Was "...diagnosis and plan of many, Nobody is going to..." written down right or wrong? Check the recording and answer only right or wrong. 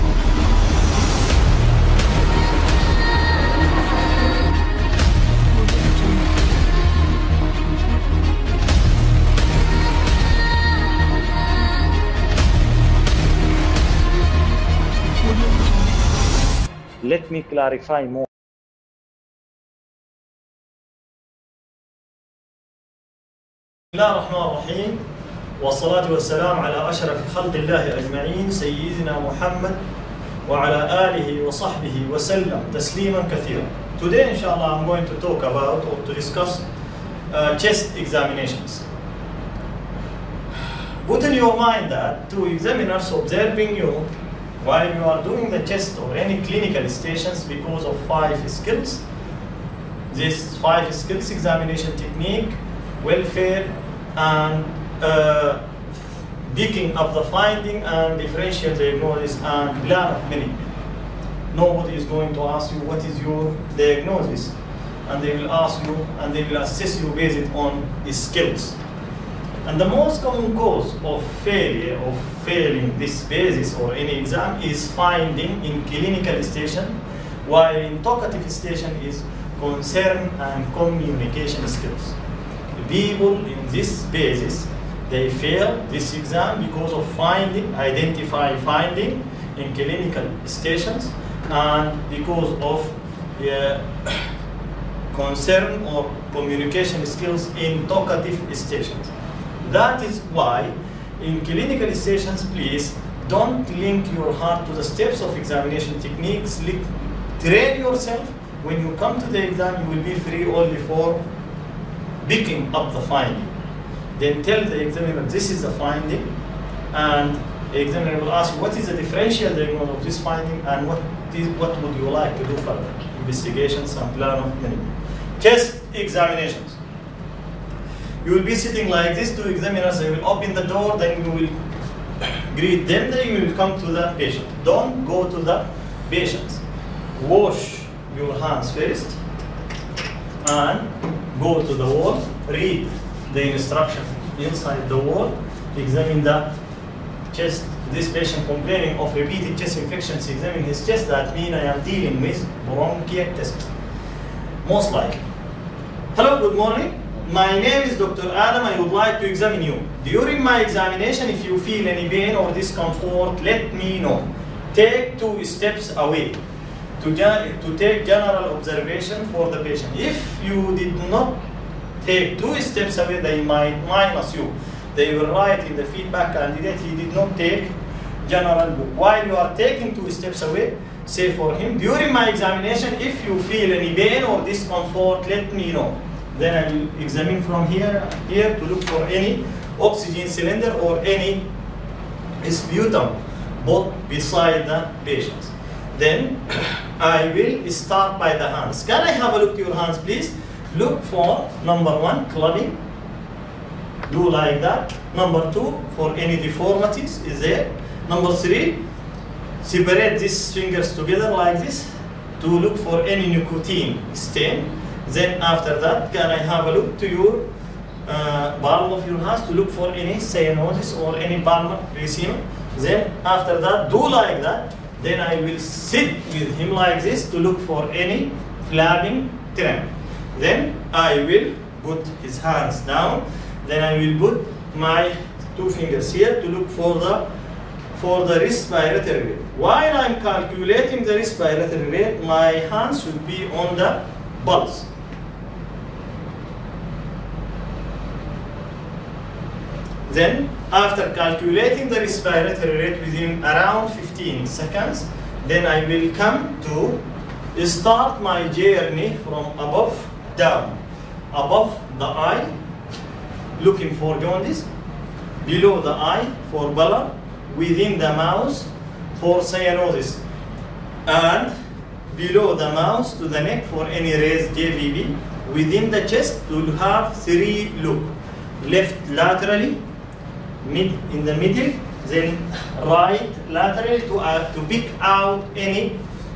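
right.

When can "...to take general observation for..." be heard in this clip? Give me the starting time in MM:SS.
02:47.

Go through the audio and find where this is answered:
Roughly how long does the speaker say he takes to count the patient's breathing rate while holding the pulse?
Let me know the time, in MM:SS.
04:13.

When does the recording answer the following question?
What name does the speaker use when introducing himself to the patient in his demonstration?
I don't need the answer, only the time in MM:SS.
02:37.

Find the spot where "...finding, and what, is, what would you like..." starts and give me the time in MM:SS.
02:00.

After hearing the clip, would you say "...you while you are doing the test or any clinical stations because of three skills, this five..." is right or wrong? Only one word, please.
wrong.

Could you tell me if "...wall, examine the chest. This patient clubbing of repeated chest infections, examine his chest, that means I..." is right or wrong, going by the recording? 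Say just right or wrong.
wrong.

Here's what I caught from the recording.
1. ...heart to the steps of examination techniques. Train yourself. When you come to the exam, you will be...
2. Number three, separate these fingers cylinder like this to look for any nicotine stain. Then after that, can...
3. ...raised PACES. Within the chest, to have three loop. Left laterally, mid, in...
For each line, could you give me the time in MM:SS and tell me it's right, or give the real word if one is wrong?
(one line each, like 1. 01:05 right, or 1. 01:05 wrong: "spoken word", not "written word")
1. 01:44 right
2. 03:28 wrong: "together", not "cylinder"
3. 04:34 wrong: "JVP", not "PACES".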